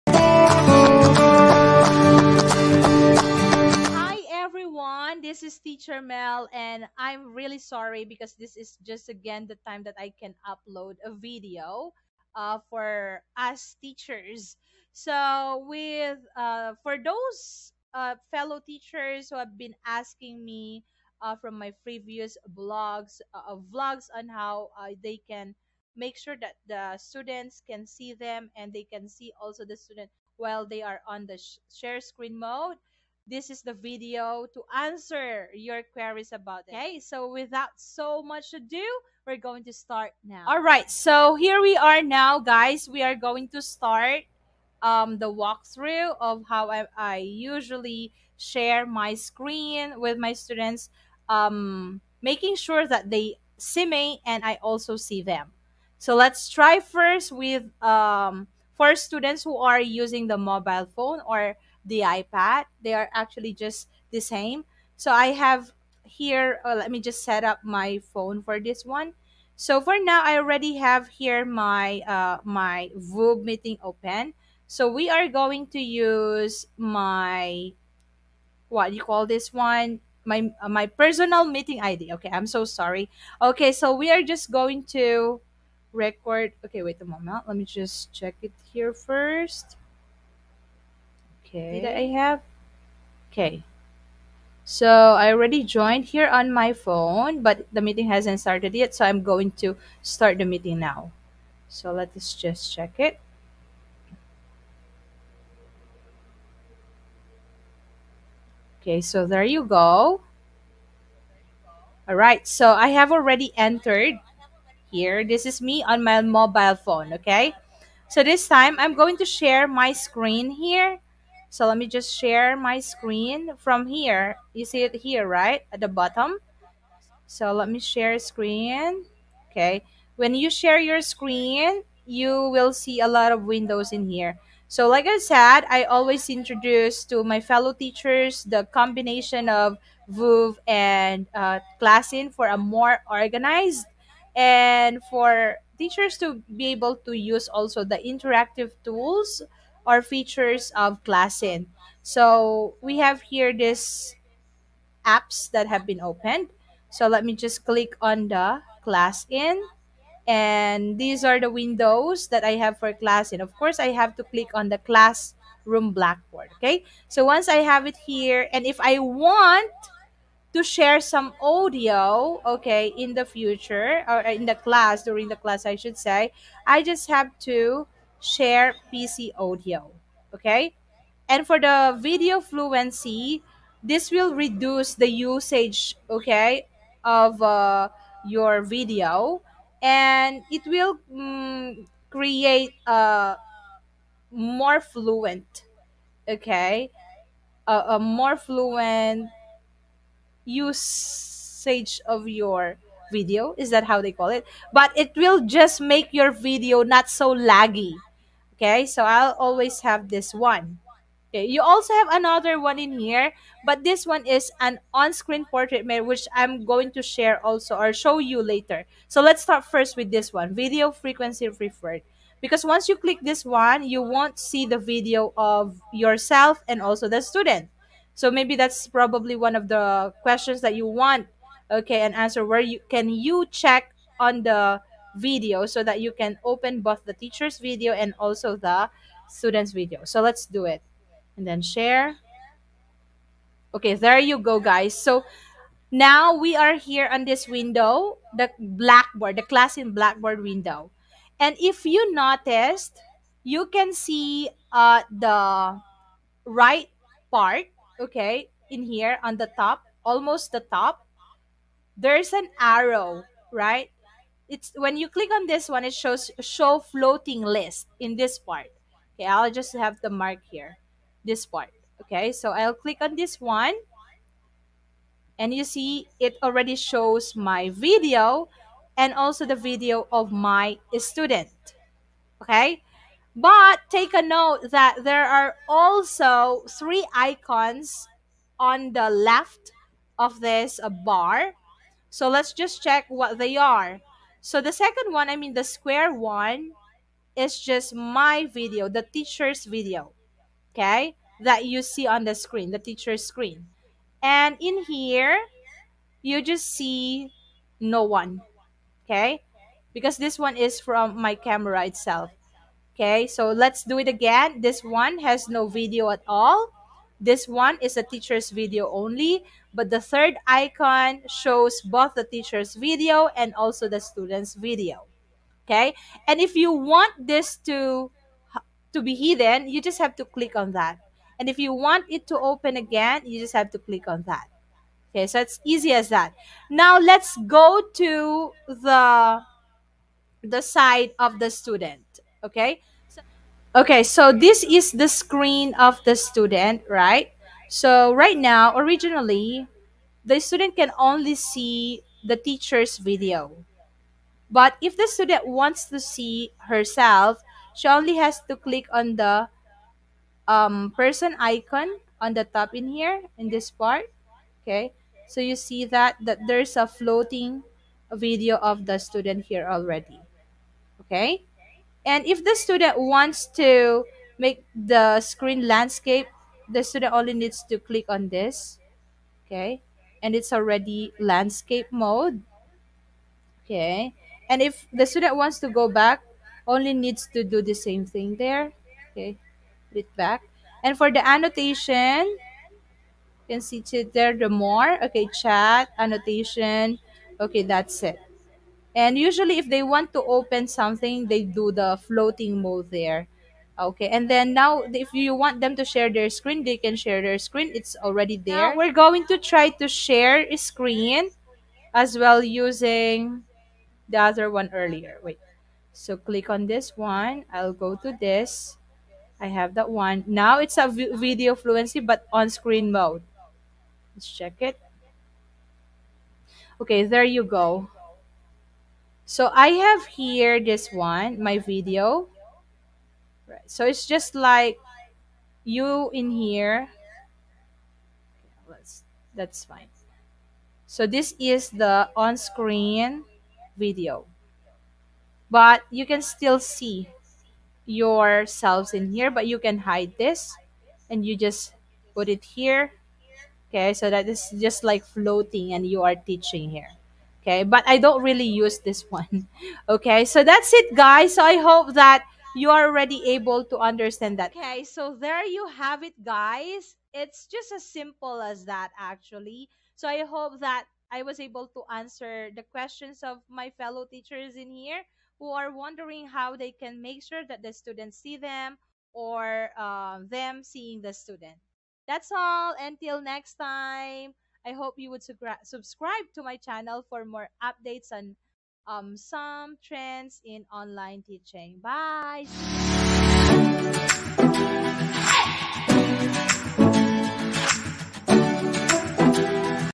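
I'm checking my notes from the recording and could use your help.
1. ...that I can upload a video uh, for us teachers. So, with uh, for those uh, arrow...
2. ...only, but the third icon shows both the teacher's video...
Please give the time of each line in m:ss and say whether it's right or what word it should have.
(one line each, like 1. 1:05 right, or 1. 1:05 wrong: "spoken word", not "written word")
1. 0:09 wrong: "fellow", not "arrow"
2. 5:18 right.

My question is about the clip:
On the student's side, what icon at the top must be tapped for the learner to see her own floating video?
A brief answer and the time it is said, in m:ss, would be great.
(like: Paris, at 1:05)
Person icon, at 6:00.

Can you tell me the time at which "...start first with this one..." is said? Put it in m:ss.
3:39.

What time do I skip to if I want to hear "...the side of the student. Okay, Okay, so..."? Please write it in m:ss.
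5:40.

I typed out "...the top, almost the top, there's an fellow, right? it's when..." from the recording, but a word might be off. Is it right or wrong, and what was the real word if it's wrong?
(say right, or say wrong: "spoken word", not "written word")
wrong: "arrow", not "fellow".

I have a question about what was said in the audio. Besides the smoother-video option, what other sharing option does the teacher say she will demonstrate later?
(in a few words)
On-screen portrait mirror.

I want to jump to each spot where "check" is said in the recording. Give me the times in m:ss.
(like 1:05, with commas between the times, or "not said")
1:28, 1:42, 3:53, 4:52, 7:04.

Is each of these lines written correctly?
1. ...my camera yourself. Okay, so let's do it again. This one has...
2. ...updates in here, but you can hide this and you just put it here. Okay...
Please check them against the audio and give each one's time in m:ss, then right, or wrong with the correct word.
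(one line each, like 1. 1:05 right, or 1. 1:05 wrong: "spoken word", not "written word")
1. 5:11 wrong: "itself", not "yourself"
2. 7:27 wrong: "yourselves", not "updates".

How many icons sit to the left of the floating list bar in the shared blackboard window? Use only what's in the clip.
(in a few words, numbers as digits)
3.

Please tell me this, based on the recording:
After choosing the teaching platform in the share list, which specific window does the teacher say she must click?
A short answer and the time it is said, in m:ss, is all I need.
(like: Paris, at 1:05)
Classroom Blackboard, at 2:44.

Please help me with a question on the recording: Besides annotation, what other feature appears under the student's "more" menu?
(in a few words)
Chat.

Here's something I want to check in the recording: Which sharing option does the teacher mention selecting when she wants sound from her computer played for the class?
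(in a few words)
Share PC audio.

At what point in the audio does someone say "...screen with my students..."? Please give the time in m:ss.
0:49.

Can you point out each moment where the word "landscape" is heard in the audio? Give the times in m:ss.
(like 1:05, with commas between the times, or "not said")
6:15, 6:21.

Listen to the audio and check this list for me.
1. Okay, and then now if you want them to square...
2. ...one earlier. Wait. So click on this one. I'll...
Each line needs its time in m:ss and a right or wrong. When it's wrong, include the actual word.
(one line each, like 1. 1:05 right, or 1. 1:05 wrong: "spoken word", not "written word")
1. 6:43 wrong: "share", not "square"
2. 6:54 right.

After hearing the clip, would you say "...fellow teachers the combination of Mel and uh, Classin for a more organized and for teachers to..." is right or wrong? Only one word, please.
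wrong.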